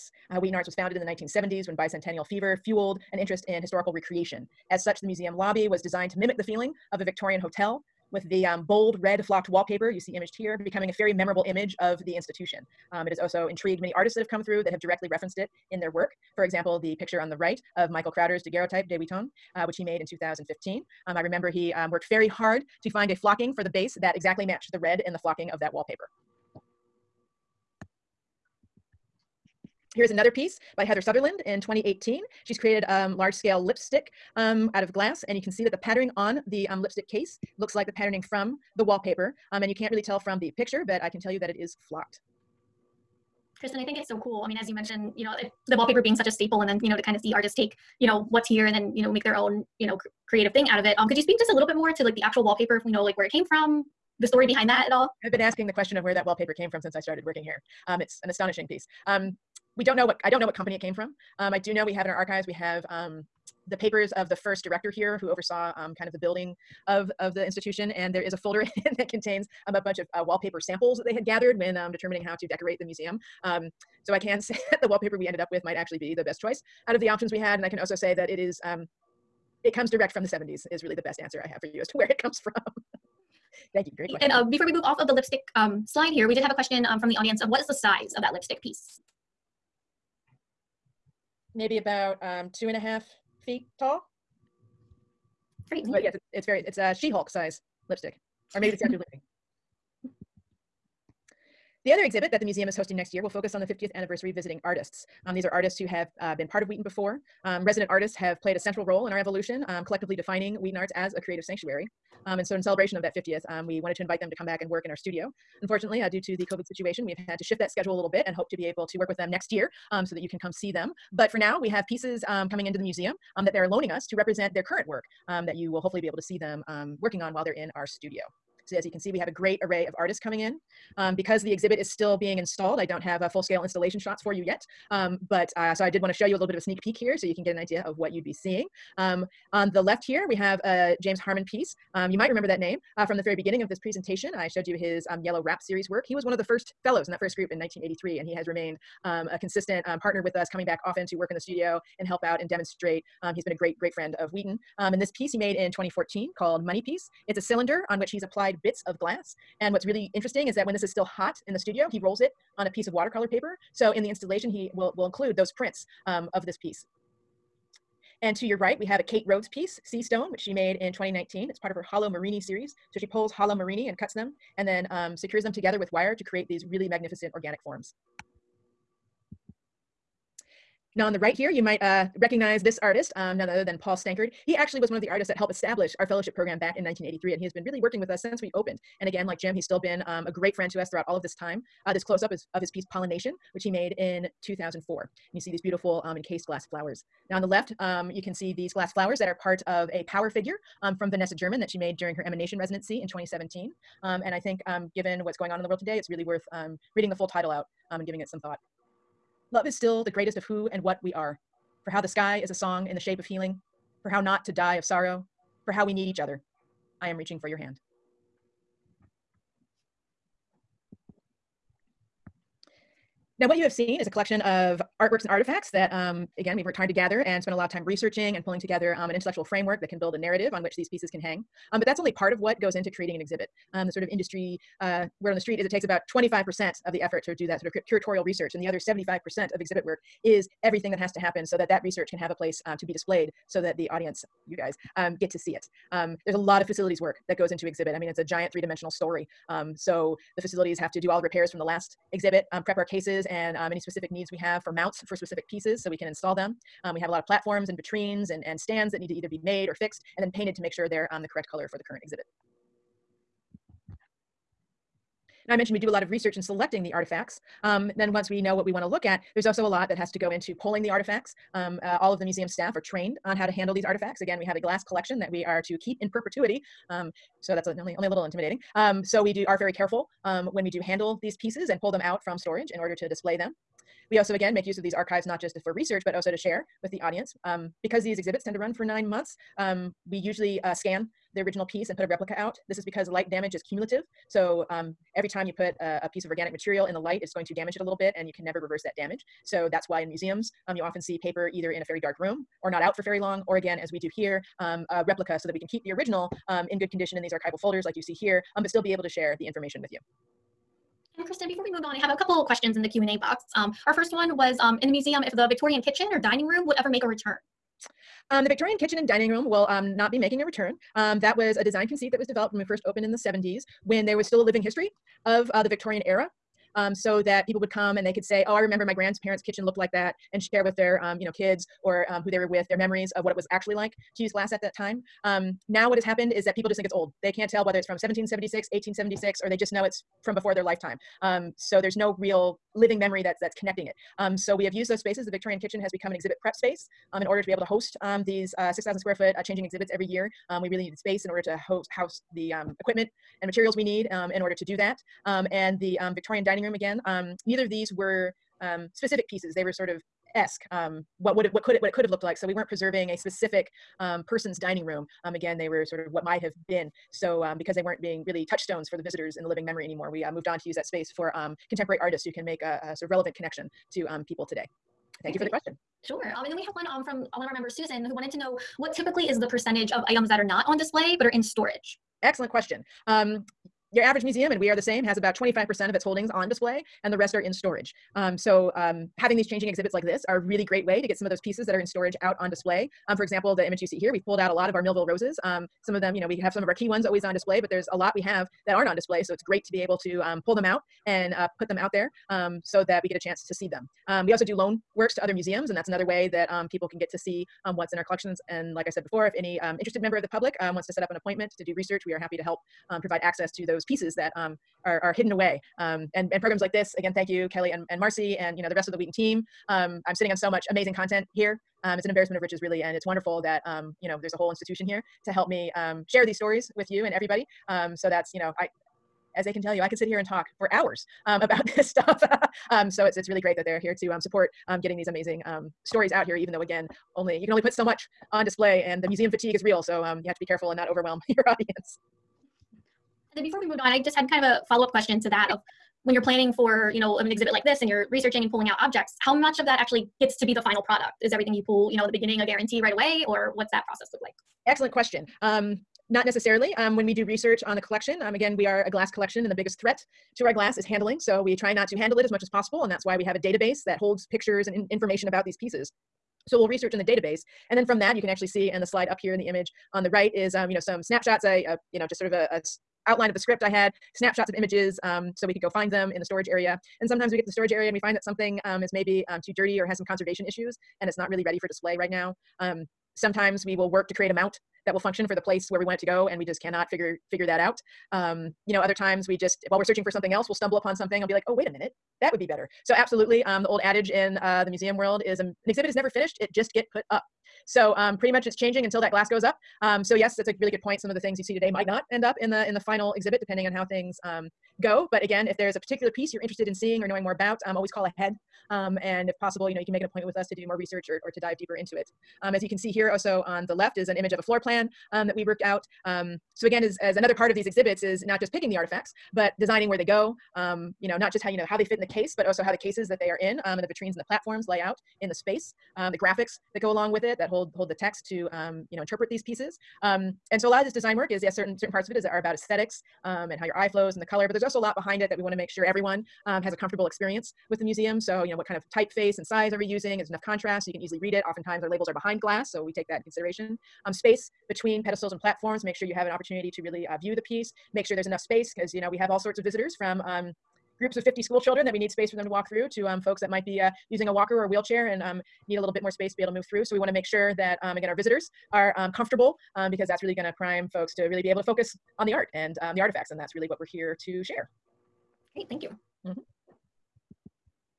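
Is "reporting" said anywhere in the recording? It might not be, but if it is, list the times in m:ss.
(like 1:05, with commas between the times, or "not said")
not said.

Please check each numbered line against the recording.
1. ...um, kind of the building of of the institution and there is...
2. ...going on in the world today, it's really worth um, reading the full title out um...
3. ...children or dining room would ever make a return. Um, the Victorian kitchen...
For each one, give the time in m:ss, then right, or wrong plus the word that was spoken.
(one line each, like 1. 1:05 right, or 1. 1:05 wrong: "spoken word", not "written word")
1. 1:05 right
2. 3:25 right
3. 5:15 wrong: "kitchen", not "children".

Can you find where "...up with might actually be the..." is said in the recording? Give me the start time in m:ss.
1:15.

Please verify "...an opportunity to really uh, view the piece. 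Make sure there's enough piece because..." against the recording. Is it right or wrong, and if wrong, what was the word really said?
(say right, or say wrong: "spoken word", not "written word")
wrong: "space", not "piece".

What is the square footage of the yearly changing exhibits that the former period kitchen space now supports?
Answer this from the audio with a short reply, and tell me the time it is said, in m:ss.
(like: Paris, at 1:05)
6,000 square feet, at 5:48.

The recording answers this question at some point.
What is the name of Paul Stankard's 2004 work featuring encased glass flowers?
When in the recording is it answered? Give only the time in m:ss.
3:12.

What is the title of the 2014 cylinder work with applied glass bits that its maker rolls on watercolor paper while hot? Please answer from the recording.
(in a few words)
Money Piece.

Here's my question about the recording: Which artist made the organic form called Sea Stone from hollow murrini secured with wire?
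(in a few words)
Kait Rhoads.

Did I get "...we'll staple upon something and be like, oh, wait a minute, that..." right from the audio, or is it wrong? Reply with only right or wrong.
wrong.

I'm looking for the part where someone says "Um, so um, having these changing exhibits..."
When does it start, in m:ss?
6:28.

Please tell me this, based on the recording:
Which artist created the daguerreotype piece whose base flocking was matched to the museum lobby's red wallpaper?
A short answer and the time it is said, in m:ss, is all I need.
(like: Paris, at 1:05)
Michael Crowder, at 0:17.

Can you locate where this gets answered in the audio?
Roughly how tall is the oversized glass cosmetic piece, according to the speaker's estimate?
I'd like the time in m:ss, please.
1:32.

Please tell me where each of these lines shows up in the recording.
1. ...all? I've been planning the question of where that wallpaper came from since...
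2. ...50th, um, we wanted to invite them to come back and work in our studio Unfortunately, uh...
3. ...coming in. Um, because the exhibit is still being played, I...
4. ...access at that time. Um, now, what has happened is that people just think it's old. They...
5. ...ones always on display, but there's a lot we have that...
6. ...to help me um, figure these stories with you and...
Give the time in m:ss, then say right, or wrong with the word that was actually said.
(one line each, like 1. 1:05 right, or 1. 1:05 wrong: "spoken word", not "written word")
1. 0:54 wrong: "asking", not "planning"
2. 1:53 right
3. 2:10 wrong: "installed", not "played"
4. 5:34 wrong: "glass", not "access"
5. 6:36 right
6. 7:05 wrong: "share", not "figure".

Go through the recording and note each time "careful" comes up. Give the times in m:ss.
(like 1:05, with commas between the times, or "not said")
4:39, 7:20.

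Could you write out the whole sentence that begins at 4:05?
Um, there's a lot of facilities work that goes into exhibit.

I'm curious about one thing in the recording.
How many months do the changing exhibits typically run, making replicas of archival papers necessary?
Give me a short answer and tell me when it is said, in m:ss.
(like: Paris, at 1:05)
9, at 4:48.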